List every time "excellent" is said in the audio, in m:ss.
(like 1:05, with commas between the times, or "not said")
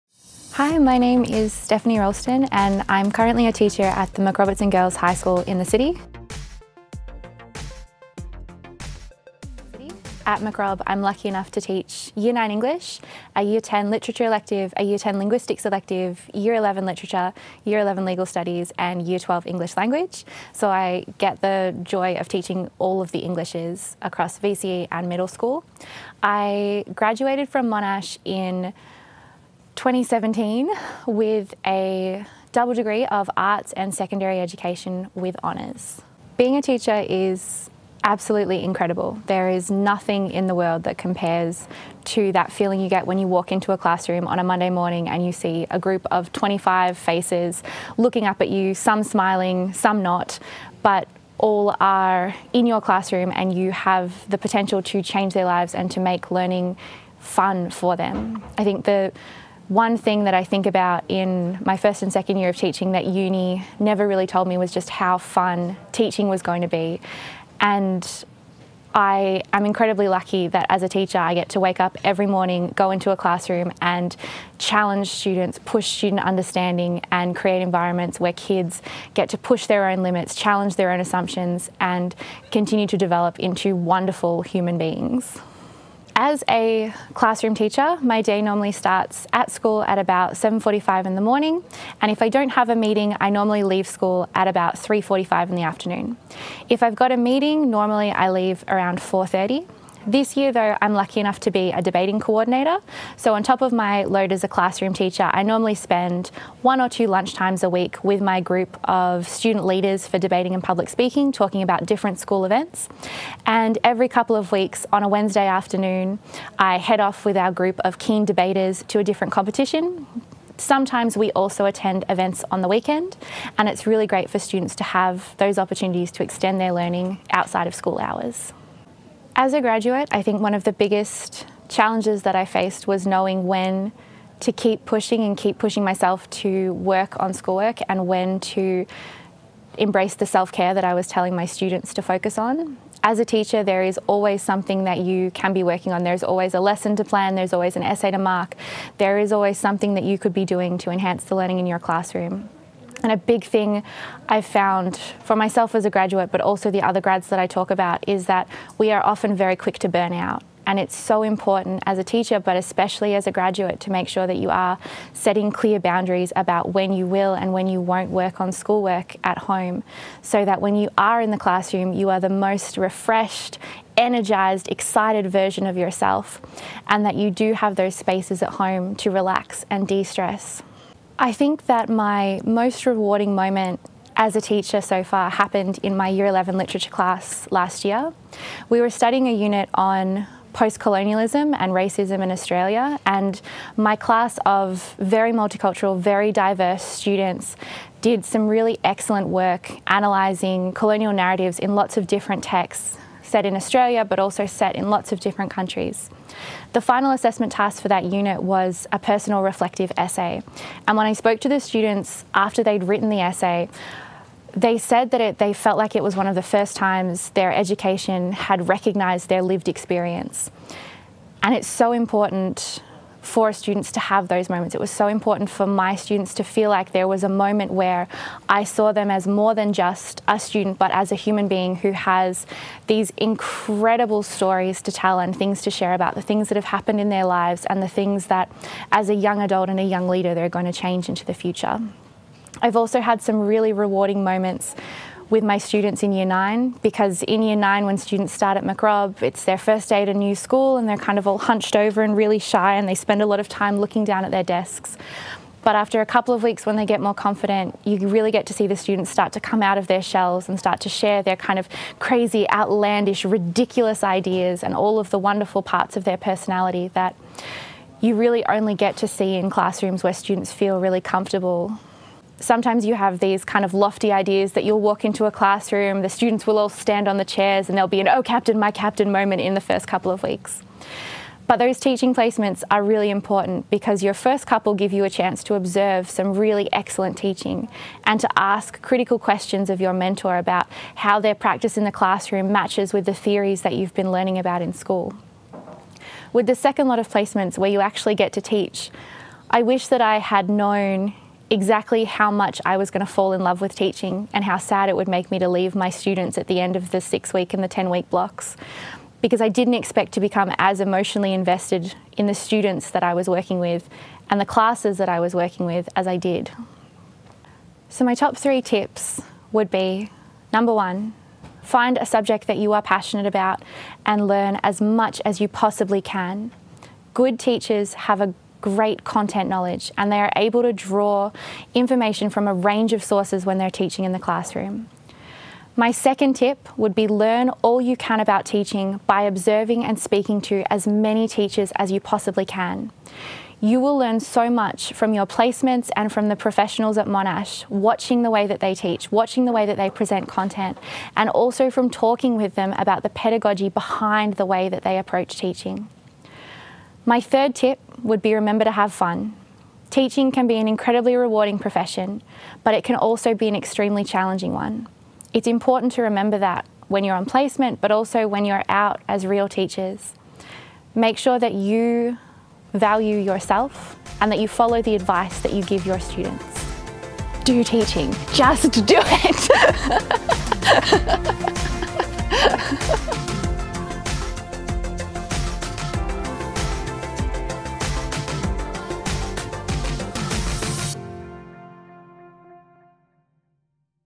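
3:18, 4:46.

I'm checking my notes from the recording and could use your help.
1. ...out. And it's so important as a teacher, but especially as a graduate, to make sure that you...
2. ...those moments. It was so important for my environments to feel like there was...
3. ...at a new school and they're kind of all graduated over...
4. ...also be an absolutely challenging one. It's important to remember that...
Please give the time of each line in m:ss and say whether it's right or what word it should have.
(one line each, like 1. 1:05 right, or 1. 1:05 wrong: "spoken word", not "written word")
1. 2:40 right
2. 3:44 wrong: "students", not "environments"
3. 4:10 wrong: "hunched", not "graduated"
4. 6:02 wrong: "extremely", not "absolutely".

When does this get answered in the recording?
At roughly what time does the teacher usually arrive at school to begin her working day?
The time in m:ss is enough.
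1:30.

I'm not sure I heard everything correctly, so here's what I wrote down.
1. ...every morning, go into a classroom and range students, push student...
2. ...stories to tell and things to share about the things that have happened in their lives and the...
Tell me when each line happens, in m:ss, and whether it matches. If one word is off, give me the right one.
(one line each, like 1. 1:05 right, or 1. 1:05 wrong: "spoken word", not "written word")
1. 1:12 wrong: "challenge", not "range"
2. 3:54 right.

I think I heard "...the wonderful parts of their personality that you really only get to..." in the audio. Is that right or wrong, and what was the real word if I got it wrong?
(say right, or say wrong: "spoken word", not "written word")
right.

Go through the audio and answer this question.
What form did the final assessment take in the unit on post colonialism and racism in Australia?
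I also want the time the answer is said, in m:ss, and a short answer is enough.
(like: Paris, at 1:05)
Personal reflective essay, at 3:28.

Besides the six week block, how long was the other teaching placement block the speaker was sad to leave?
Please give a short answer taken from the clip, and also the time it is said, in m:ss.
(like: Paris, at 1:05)
10 weeks, at 5:07.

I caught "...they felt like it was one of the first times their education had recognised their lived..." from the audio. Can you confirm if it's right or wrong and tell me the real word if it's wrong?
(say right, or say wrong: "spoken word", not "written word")
right.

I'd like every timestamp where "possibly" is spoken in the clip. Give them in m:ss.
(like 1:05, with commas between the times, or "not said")
5:25, 5:41.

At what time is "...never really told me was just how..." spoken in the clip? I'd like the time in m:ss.
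1:03.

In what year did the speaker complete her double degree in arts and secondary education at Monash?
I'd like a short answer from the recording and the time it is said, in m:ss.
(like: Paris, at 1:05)
2017, at 0:29.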